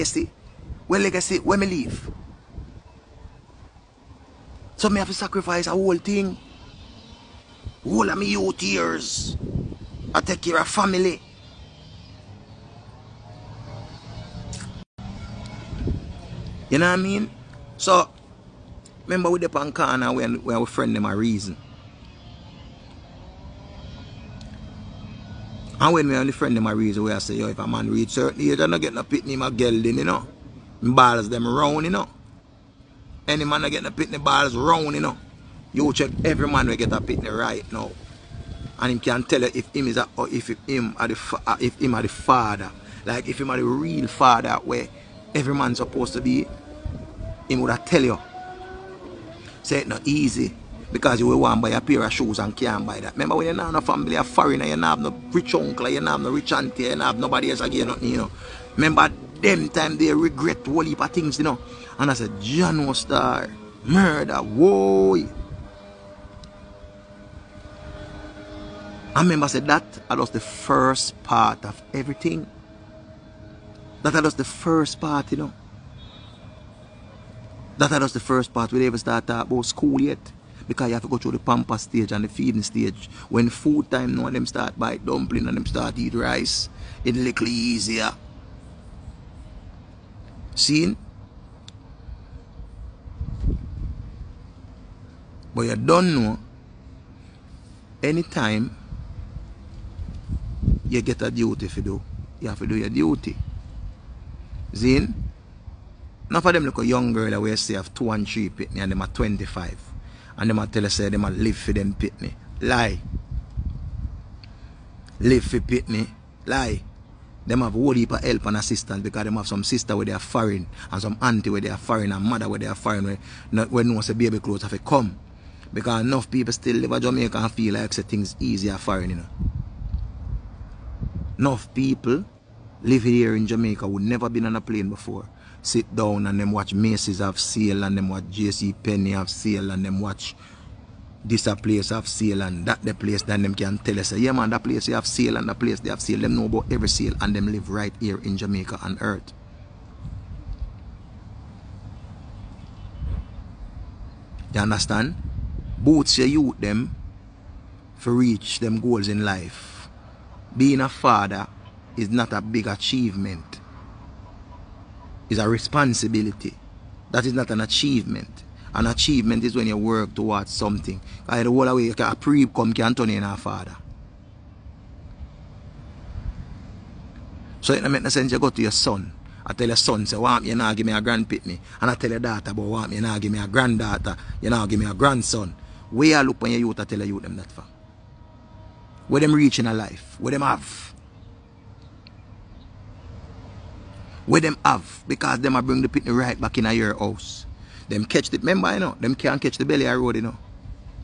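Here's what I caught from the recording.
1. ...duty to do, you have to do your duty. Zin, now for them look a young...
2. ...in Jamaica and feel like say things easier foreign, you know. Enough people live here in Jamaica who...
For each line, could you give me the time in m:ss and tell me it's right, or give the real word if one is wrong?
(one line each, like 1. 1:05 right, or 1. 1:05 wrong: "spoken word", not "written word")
1. 1:41 right
2. 2:06 right.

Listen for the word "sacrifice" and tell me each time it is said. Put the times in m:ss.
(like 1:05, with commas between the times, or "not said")
0:05.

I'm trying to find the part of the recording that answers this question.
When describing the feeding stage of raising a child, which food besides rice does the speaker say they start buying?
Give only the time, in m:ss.
1:24.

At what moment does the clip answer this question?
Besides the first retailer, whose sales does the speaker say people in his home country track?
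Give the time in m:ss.
2:18.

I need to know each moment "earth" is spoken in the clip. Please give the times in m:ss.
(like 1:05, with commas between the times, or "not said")
2:29.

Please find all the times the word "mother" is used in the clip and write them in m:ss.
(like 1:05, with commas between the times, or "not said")
2:02.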